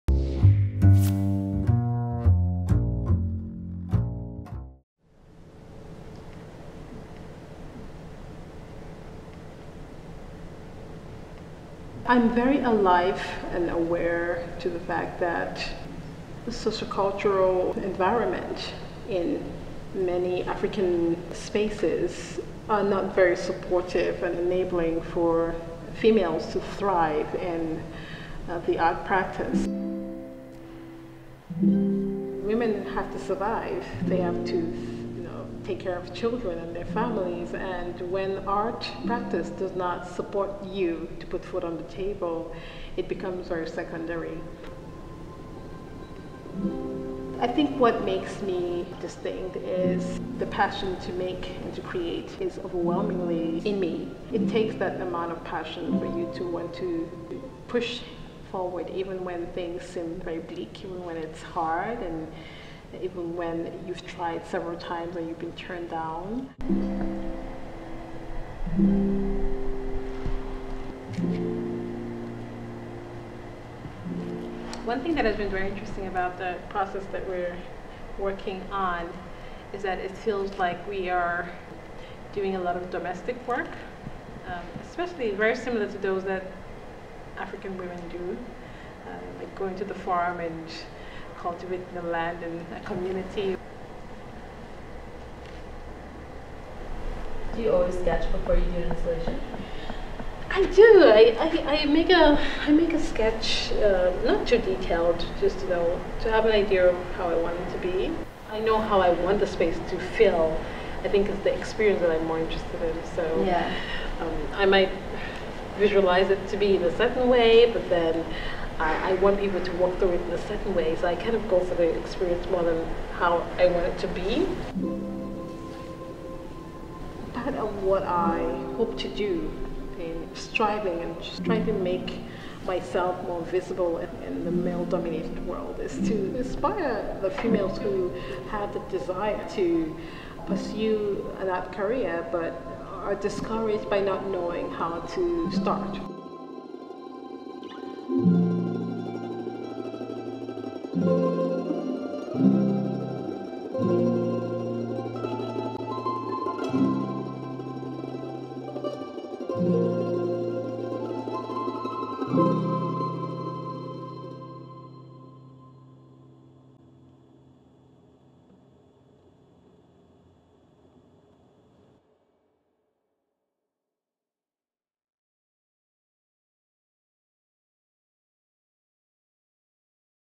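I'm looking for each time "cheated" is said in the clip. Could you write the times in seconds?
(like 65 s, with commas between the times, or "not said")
not said.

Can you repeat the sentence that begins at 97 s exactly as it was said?
Do you always sketch before you do an installation?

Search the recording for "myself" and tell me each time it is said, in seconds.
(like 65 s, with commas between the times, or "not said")
132 s.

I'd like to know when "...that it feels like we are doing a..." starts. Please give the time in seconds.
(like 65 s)
79 s.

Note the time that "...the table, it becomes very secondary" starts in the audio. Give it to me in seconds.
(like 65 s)
41 s.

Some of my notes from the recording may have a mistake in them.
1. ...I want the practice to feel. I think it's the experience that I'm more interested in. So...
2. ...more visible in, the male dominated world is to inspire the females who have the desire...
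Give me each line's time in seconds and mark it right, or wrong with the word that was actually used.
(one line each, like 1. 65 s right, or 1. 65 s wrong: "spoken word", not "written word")
1. 109 s wrong: "space", not "practice"
2. 133 s right.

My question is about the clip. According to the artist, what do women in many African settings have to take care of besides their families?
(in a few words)
children.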